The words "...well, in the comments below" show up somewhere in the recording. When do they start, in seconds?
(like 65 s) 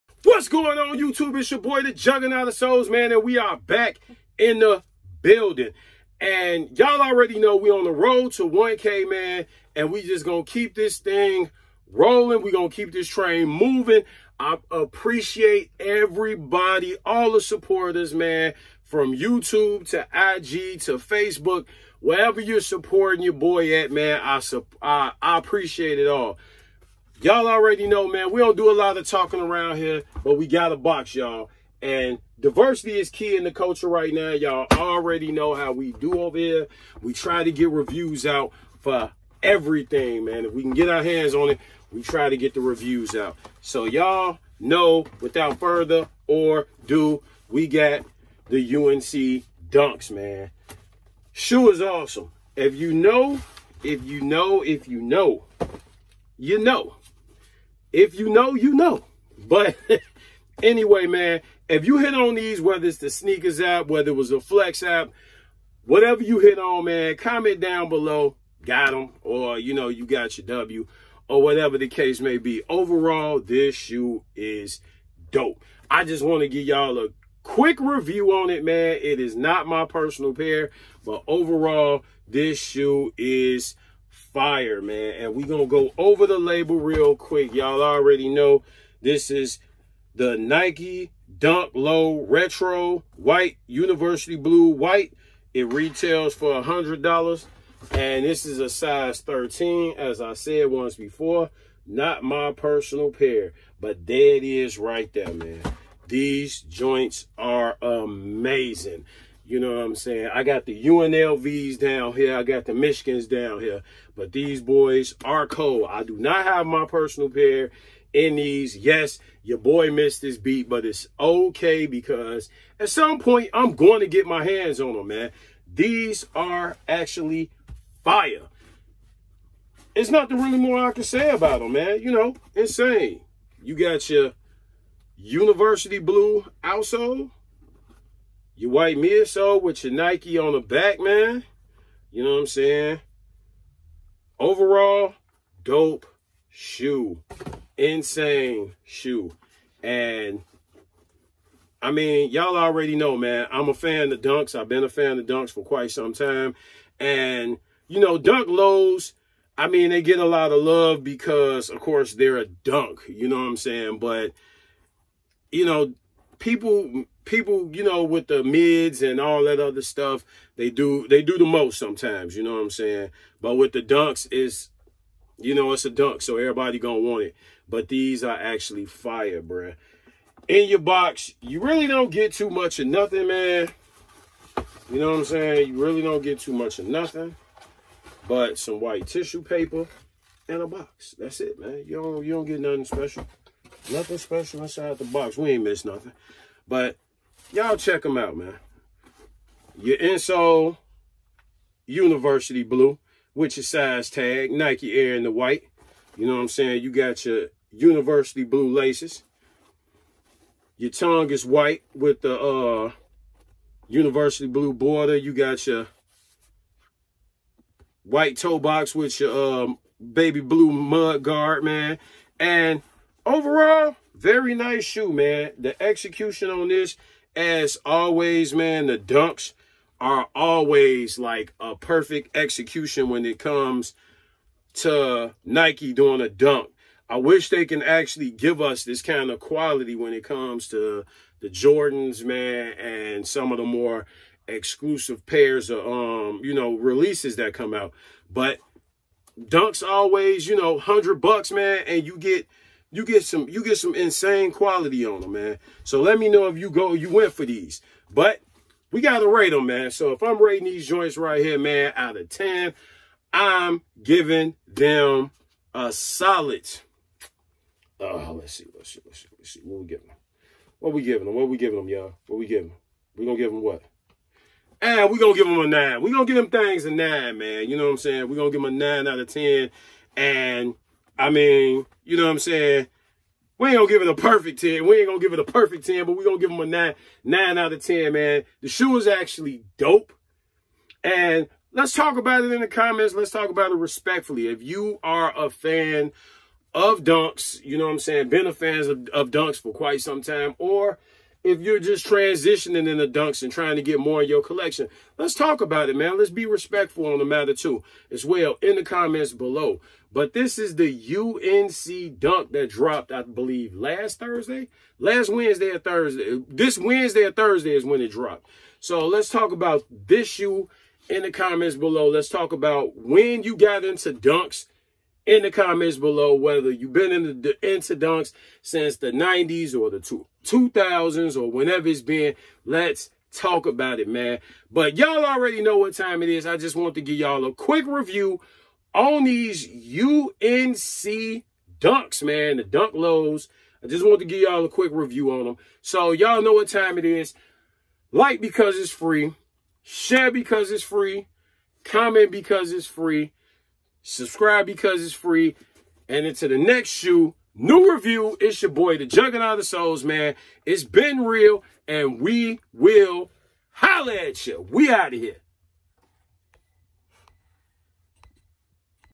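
308 s.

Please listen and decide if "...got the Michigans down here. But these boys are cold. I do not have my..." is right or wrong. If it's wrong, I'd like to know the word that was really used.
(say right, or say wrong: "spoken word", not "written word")
right.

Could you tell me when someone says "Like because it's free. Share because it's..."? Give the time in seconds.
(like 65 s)
348 s.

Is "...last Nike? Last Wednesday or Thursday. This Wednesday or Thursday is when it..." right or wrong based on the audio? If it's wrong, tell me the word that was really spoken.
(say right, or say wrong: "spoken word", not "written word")
wrong: "Thursday", not "Nike".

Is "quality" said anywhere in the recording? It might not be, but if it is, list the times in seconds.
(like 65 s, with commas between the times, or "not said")
239 s, 254 s.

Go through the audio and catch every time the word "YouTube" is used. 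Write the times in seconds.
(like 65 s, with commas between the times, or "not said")
0 s, 19 s.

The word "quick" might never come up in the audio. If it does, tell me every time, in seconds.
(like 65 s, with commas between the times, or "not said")
77 s, 87 s, 337 s, 344 s.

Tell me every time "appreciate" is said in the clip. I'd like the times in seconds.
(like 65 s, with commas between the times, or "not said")
14 s, 25 s.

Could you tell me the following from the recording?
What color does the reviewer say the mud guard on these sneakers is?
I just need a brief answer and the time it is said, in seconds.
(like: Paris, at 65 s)
Baby blue, at 220 s.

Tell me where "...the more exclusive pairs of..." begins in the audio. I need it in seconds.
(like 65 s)
243 s.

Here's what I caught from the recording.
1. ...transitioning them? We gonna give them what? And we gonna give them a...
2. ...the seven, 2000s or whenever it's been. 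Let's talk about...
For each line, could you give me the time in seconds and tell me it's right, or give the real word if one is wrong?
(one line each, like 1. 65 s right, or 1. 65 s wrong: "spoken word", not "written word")
1. 272 s wrong: "giving", not "transitioning"
2. 329 s wrong: "two", not "seven".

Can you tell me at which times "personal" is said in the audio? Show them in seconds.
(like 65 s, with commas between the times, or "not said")
79 s, 102 s, 116 s.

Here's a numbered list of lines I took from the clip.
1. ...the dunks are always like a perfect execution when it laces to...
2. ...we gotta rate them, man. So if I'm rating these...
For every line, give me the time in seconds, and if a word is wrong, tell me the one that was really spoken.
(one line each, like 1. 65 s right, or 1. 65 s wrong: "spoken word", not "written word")
1. 228 s wrong: "comes", not "laces"
2. 258 s right.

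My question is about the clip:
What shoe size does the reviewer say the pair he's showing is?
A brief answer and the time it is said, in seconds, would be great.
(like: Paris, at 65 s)
13, at 98 s.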